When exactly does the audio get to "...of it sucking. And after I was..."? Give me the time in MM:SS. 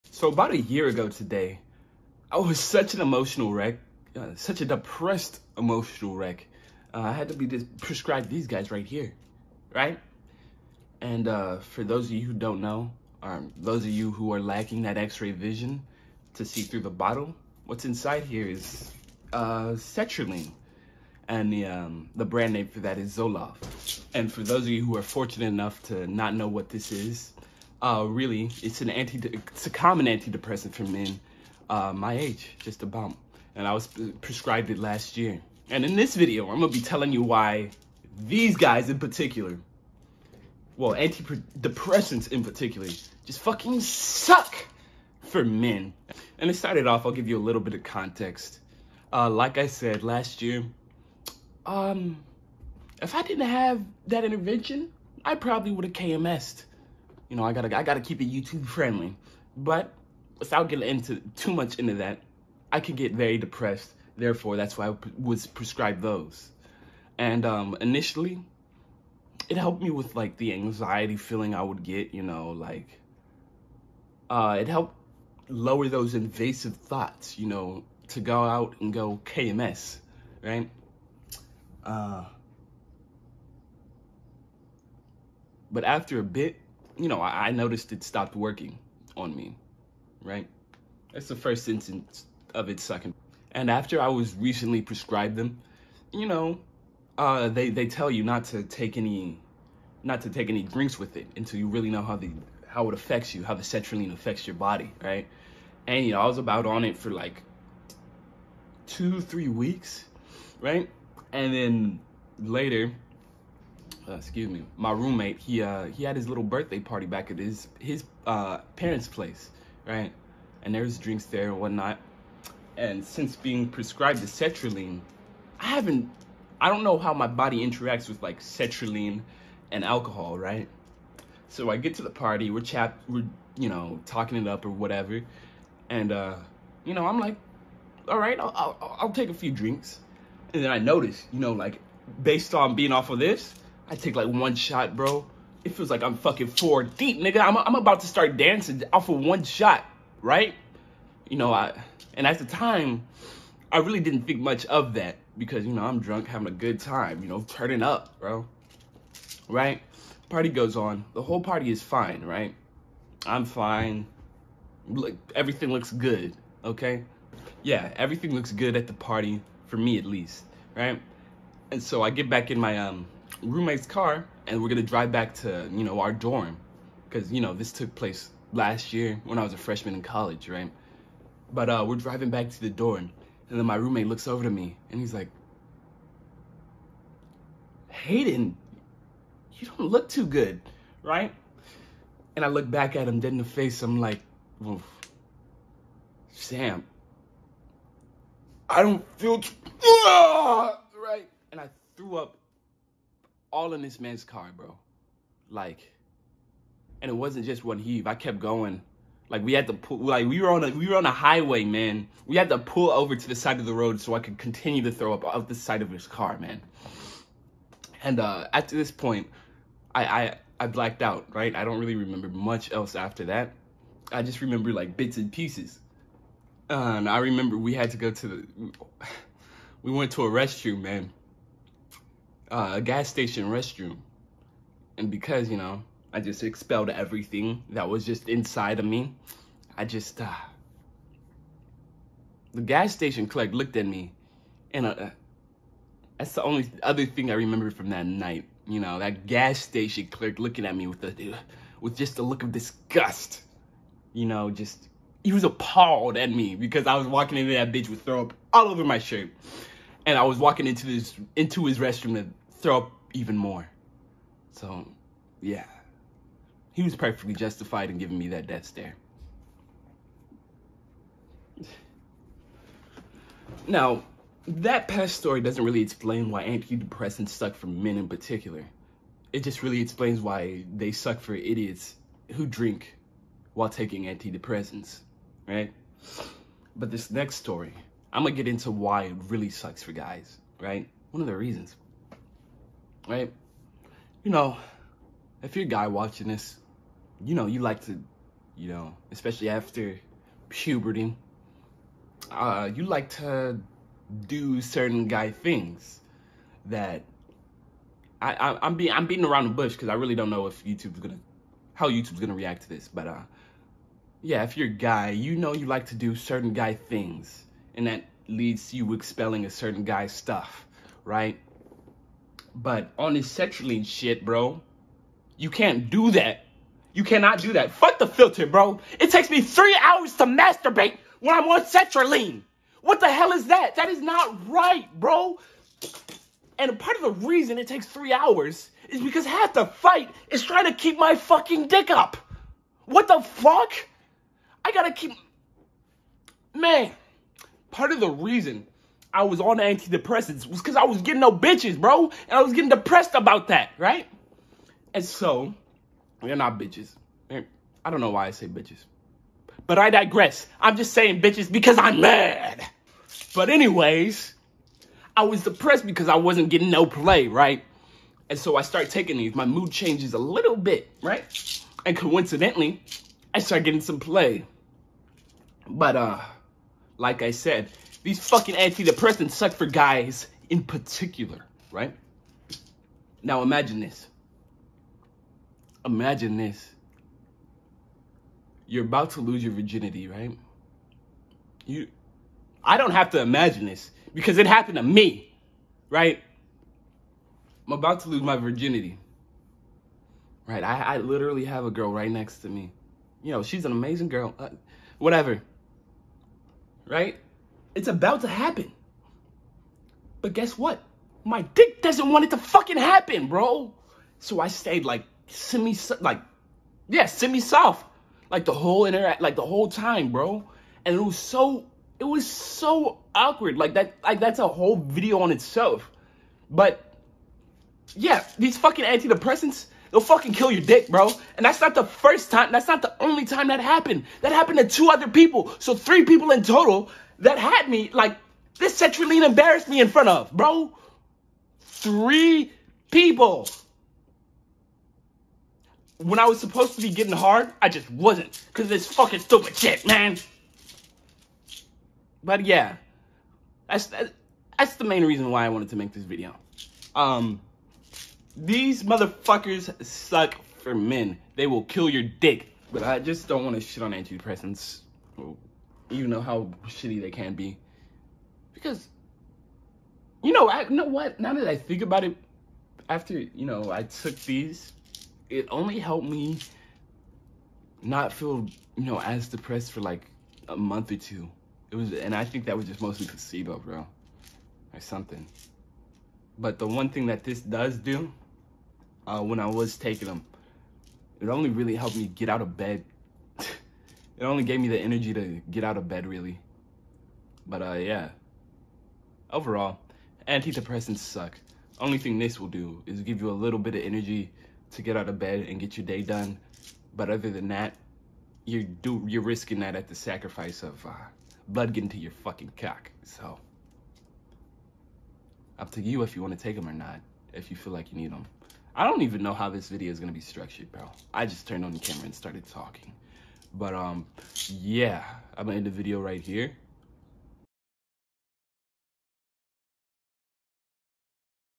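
01:32.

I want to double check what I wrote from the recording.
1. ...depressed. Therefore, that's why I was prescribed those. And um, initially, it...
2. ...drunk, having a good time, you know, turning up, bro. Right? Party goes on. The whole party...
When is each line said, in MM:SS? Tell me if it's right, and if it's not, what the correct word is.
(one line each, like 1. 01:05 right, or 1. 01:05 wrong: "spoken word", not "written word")
1. 01:03 right
2. 02:35 right.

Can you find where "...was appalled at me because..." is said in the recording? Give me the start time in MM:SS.
04:15.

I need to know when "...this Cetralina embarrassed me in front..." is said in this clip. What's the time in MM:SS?
07:18.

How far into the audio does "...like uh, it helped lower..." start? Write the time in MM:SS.
01:12.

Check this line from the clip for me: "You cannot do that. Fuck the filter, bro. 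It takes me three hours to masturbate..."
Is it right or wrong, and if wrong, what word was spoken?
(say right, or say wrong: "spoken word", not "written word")
right.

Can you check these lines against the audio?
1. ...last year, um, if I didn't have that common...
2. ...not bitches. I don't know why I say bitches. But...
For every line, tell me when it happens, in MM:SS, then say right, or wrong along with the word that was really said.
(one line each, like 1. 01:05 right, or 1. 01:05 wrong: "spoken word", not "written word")
1. 00:50 wrong: "intervention", not "common"
2. 05:56 right.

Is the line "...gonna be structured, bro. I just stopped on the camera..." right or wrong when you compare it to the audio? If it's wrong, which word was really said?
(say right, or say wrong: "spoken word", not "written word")
wrong: "turned", not "stopped".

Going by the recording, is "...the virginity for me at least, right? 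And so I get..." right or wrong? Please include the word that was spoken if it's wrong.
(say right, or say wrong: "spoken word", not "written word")
wrong: "party", not "virginity".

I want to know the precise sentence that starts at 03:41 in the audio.
I don't really remember much else after that.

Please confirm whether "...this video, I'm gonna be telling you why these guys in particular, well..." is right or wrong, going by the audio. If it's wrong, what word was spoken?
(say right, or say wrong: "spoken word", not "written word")
right.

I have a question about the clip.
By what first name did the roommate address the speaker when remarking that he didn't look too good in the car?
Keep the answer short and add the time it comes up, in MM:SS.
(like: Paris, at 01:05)
Hayden, at 03:07.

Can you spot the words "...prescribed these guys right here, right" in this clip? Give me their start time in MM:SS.
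00:07.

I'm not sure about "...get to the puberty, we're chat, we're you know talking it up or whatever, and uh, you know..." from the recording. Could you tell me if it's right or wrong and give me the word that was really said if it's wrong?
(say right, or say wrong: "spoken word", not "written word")
wrong: "party", not "puberty".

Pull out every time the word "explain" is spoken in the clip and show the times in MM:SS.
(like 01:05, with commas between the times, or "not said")
04:35, 04:39.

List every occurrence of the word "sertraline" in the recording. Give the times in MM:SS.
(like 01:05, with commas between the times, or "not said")
00:19, 01:43, 02:04, 02:08, 05:31.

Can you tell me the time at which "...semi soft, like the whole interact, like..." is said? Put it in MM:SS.
06:57.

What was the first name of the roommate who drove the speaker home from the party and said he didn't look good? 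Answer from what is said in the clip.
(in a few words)
Sam.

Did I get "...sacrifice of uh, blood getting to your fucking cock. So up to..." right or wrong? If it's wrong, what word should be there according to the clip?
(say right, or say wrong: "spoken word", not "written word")
right.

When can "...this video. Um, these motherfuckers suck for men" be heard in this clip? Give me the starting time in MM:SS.
07:35.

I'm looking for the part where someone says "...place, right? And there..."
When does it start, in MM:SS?
01:59.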